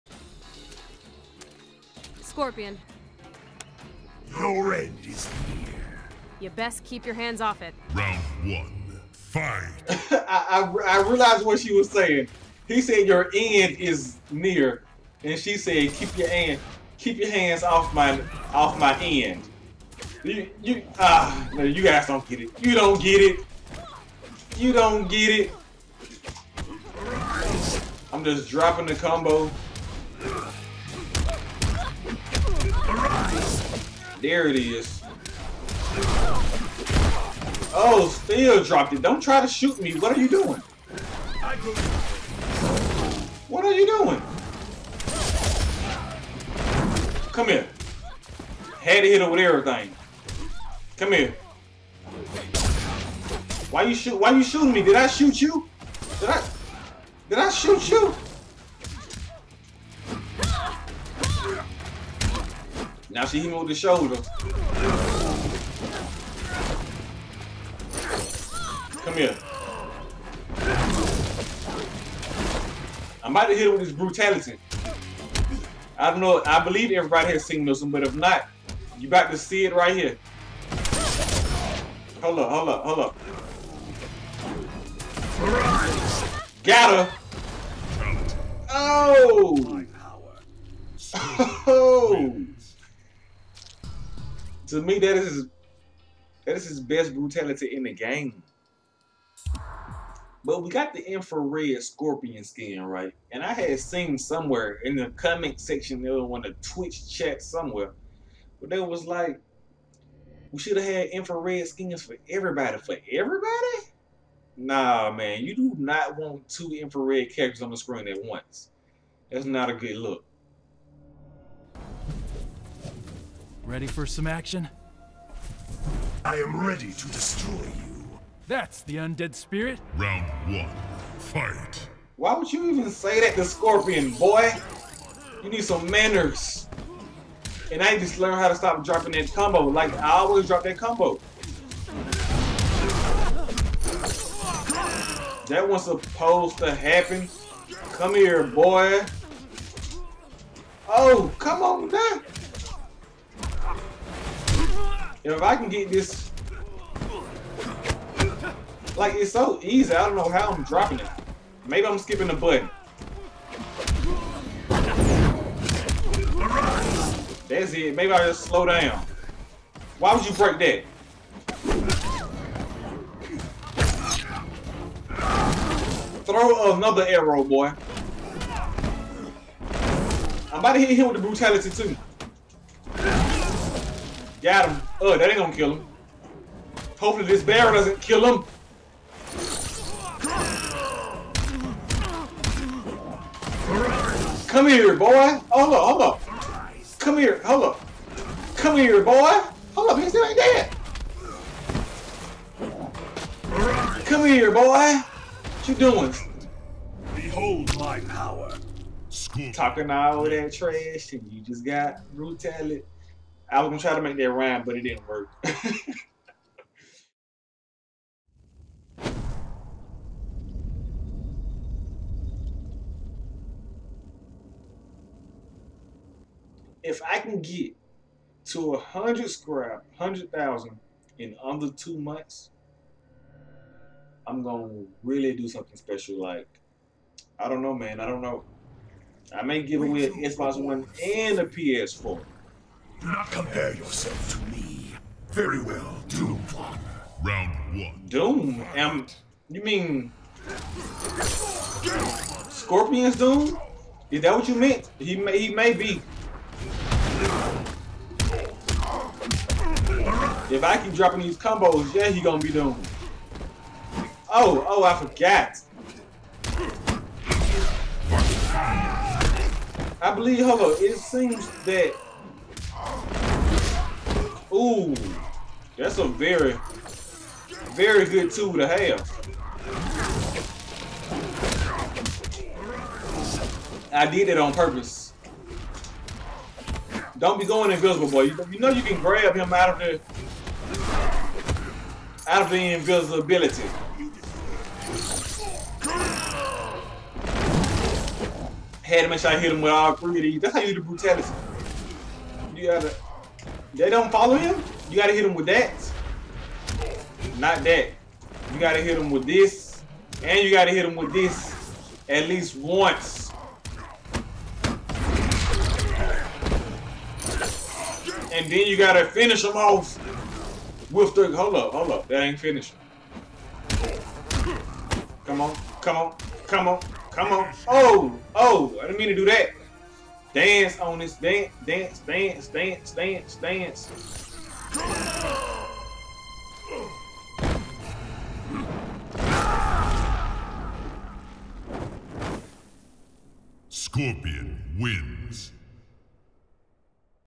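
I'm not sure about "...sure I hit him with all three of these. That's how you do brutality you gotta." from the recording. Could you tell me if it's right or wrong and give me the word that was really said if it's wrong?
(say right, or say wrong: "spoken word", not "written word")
right.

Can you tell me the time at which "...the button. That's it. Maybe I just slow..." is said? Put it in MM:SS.
02:42.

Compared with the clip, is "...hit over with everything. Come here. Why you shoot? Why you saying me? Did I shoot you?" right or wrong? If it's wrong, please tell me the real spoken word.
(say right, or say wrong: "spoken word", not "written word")
wrong: "shooting", not "saying".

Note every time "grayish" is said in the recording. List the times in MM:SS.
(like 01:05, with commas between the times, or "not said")
not said.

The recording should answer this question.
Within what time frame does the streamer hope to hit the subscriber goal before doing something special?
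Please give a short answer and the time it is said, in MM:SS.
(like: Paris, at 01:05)
2 months, at 03:51.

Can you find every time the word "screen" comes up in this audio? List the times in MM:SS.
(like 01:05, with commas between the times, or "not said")
01:57.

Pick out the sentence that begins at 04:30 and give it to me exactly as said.
I believe, hold on, it seems that Ooh, that's a very, very good tool to have.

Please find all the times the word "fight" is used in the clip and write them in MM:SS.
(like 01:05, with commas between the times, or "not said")
00:09, 02:11.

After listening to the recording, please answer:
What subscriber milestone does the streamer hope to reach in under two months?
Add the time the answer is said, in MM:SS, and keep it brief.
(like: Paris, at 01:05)
100,000, at 03:49.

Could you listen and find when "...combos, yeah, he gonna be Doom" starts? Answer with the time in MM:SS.
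04:21.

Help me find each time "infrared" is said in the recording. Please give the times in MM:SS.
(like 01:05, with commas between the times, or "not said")
01:41, 01:51, 01:56.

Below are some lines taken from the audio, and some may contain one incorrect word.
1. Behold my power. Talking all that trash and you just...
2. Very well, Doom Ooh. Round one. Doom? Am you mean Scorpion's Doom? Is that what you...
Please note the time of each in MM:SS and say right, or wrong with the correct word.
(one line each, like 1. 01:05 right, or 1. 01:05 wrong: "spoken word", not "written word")
1. 03:27 right
2. 04:05 wrong: "One", not "Ooh".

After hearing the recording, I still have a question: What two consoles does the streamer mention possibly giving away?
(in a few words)
Xbox One and PS4.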